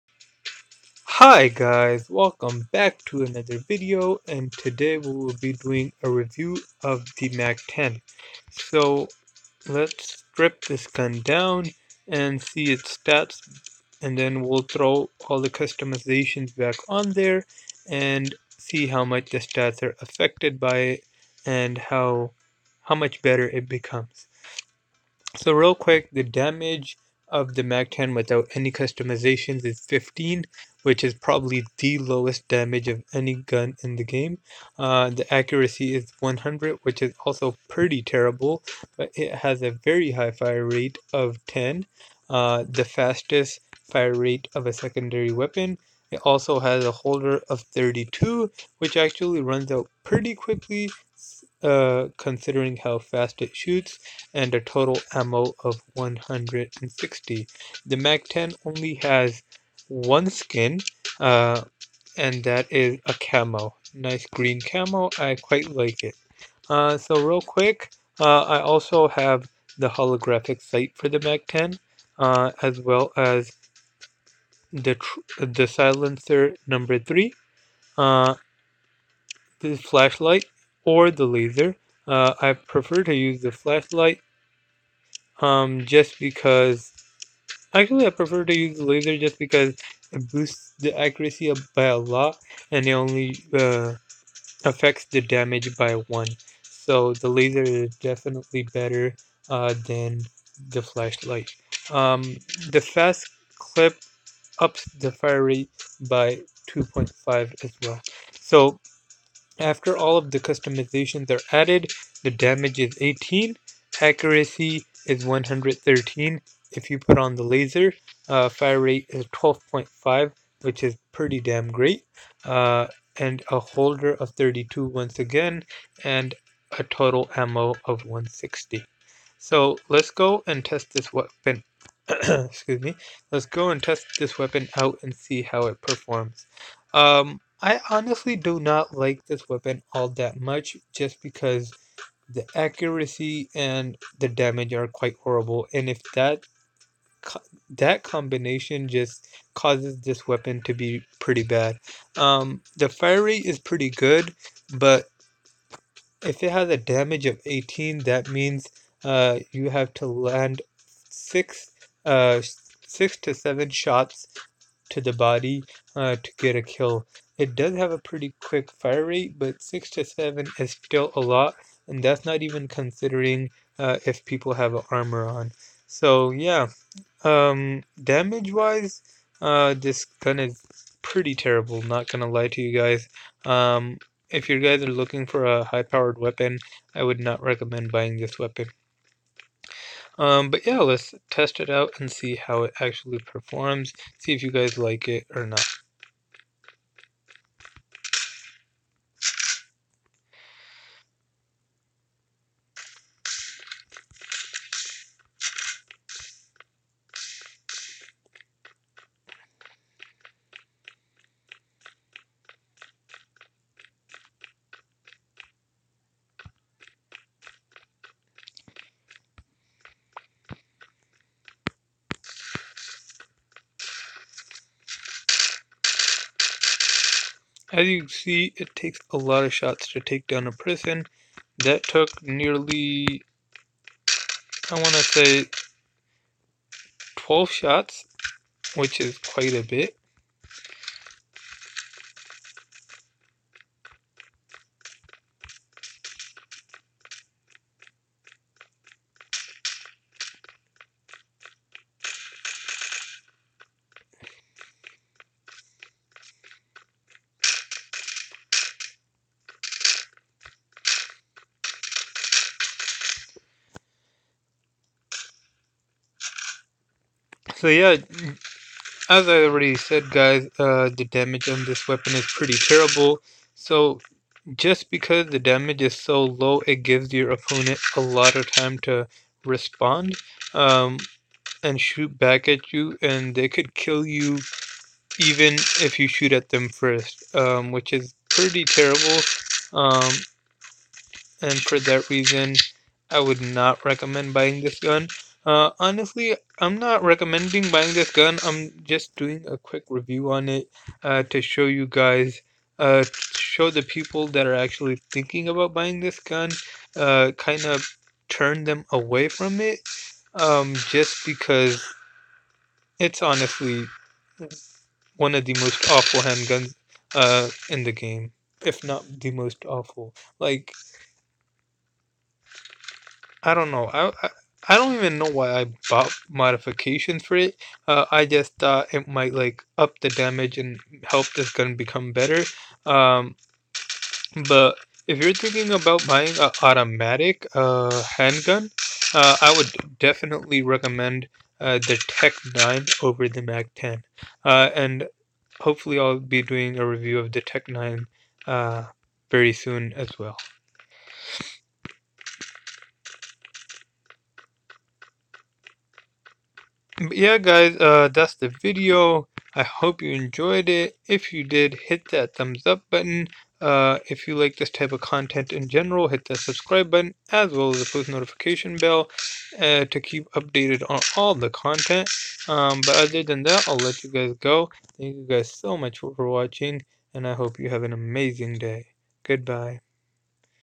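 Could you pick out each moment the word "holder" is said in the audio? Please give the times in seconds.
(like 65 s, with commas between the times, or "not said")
46 s, 123 s.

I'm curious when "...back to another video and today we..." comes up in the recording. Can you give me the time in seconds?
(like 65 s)
2 s.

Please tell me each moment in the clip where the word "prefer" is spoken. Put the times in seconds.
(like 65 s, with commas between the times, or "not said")
82 s, 88 s.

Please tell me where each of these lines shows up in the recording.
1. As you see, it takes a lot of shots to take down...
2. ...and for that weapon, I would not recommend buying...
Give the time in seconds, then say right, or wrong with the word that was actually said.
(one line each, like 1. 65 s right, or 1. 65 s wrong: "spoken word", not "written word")
1. 227 s right
2. 291 s wrong: "reason", not "weapon".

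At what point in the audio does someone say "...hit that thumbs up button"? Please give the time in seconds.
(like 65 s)
361 s.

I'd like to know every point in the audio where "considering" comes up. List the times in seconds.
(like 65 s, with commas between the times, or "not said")
52 s, 172 s.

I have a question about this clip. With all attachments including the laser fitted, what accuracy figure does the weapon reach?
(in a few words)
113.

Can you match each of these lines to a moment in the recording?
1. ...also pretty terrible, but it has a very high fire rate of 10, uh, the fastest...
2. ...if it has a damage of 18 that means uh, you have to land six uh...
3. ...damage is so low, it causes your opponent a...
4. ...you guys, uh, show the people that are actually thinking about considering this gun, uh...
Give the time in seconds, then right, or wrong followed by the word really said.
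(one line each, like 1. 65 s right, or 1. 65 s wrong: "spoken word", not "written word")
1. 37 s right
2. 156 s right
3. 275 s wrong: "gives", not "causes"
4. 301 s wrong: "buying", not "considering".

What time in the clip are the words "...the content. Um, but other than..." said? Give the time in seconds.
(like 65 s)
371 s.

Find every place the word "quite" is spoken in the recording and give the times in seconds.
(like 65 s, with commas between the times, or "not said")
65 s, 144 s, 239 s.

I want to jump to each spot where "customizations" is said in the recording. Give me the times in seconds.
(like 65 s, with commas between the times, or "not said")
15 s, 28 s, 110 s.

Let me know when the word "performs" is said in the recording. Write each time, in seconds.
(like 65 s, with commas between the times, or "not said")
135 s, 193 s.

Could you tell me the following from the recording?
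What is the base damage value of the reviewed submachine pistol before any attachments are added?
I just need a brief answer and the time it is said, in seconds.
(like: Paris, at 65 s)
15, at 29 s.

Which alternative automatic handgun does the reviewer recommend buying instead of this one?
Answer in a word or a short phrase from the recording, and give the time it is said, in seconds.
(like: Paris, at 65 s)
TEC-9, at 341 s.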